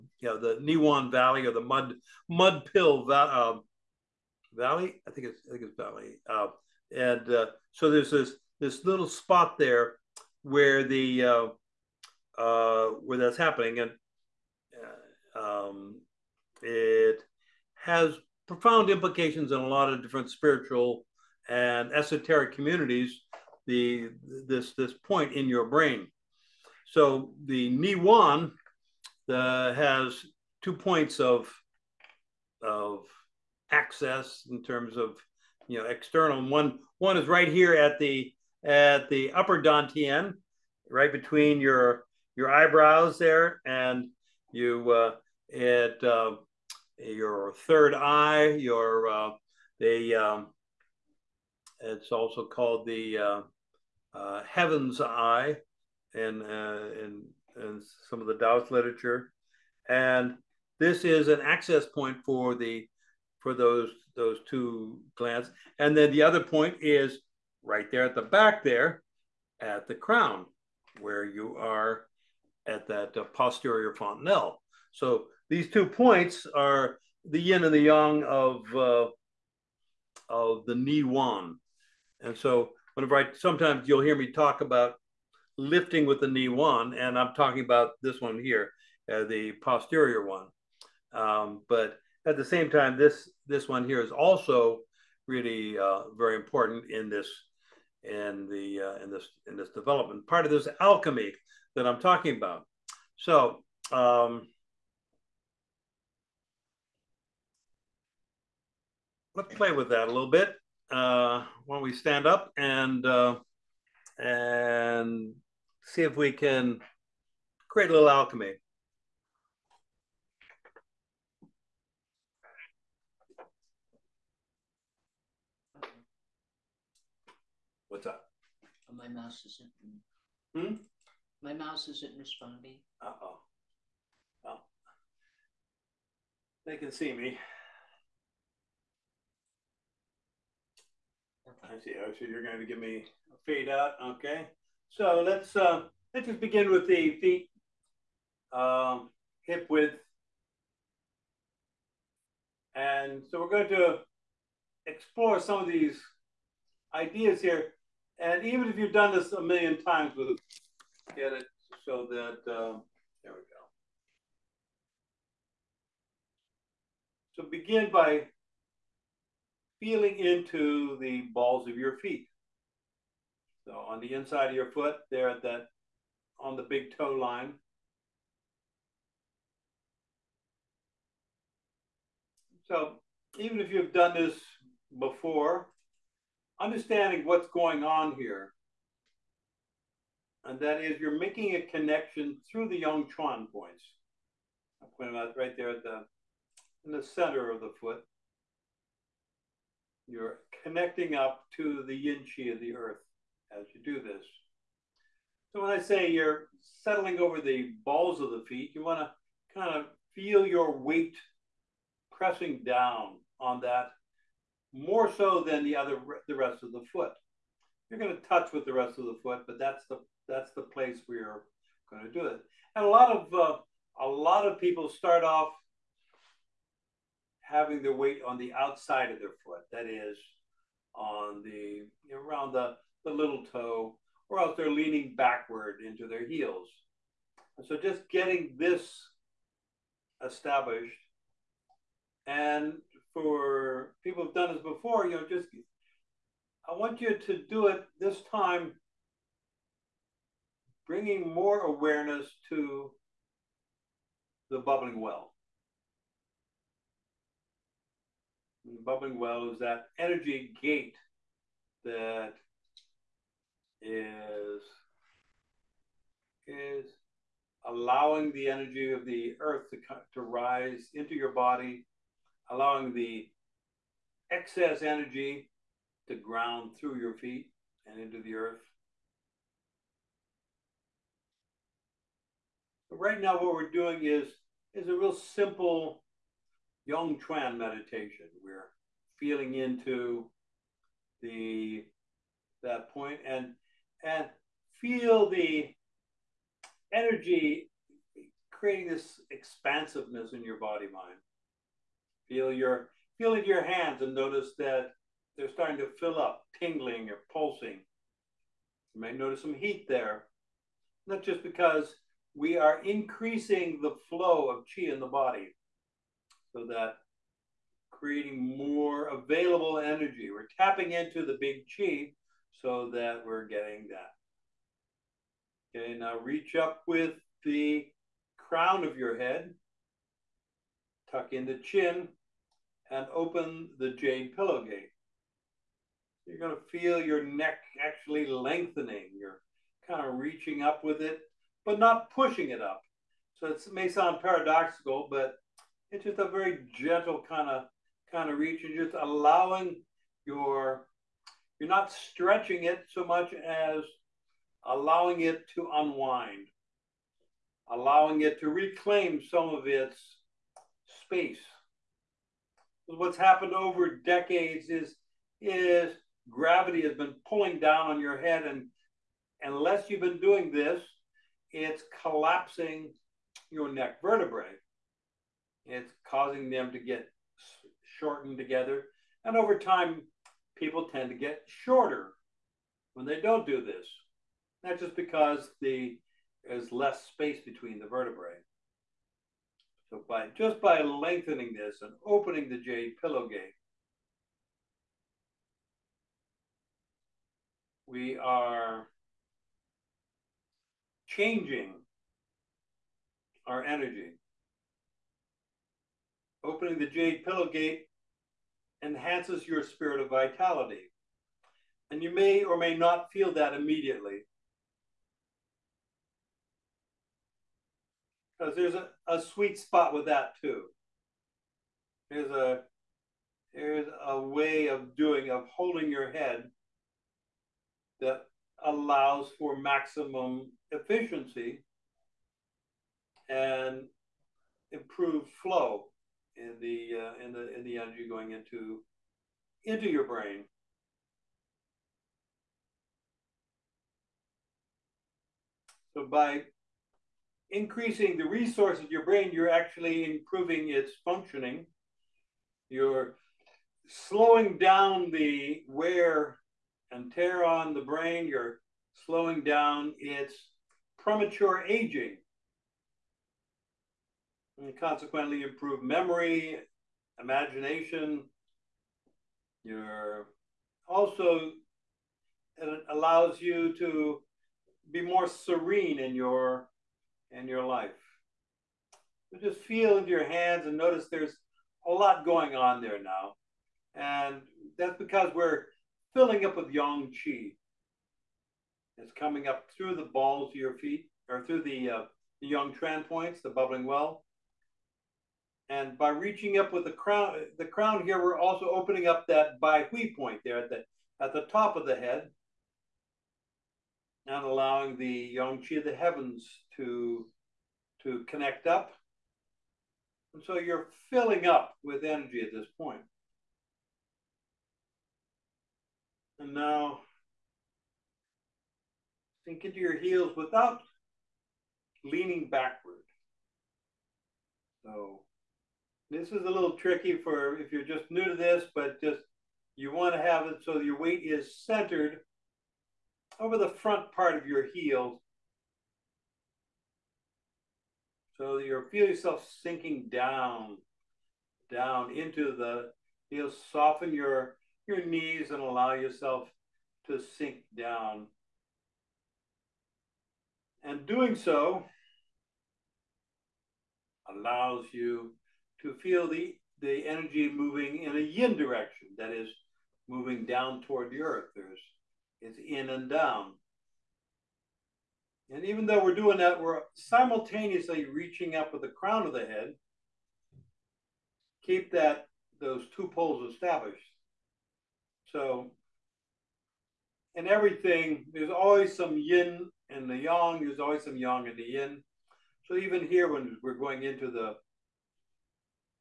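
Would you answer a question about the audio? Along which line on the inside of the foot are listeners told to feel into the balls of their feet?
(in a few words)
big toe line.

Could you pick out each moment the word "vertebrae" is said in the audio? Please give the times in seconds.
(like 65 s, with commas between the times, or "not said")
373 s, 387 s.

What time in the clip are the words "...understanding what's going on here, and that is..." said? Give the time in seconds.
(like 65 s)
186 s.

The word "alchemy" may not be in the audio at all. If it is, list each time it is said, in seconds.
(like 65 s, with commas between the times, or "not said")
100 s, 118 s.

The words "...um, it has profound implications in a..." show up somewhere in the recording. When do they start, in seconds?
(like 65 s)
15 s.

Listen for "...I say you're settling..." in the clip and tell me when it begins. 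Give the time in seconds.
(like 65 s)
205 s.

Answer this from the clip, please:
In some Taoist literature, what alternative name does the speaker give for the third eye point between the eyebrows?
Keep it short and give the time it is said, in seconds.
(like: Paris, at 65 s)
Heaven's Eye, at 54 s.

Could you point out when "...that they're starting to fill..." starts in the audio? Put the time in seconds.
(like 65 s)
304 s.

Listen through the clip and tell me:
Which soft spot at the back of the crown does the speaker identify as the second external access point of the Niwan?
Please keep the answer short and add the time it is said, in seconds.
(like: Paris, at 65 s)
posterior fontanelle, at 73 s.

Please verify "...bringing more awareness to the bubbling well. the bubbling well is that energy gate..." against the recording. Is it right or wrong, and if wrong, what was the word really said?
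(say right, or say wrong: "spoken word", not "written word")
right.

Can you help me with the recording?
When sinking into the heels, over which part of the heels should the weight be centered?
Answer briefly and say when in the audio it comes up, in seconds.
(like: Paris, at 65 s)
front part, at 533 s.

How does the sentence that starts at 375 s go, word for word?
It's causing them to get shortened together.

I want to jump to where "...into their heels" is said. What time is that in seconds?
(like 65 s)
235 s.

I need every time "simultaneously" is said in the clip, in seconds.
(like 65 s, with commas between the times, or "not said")
566 s.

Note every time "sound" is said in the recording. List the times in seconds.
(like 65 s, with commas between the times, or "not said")
343 s.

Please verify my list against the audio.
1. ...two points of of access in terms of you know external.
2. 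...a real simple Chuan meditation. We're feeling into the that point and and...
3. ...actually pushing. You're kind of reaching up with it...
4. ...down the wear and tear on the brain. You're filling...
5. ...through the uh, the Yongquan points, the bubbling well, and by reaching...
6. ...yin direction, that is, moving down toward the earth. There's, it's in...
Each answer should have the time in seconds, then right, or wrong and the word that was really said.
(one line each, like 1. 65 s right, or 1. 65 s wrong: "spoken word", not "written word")
1. 30 s right
2. 284 s right
3. 337 s wrong: "lengthening", not "pushing"
4. 454 s wrong: "slowing", not "filling"
5. 491 s right
6. 558 s right.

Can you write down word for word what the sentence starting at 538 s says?
So you feel yourself sinking down, down into the heels.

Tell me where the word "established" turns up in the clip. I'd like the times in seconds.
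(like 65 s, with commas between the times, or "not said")
240 s, 573 s.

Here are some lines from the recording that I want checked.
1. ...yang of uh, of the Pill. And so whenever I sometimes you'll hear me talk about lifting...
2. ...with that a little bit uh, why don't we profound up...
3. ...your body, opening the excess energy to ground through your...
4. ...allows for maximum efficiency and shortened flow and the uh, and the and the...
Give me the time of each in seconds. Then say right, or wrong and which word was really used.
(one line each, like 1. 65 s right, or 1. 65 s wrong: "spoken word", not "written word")
1. 77 s wrong: "Niwan", not "Pill"
2. 109 s wrong: "stand", not "profound"
3. 271 s wrong: "allowing", not "opening"
4. 428 s wrong: "improved", not "shortened".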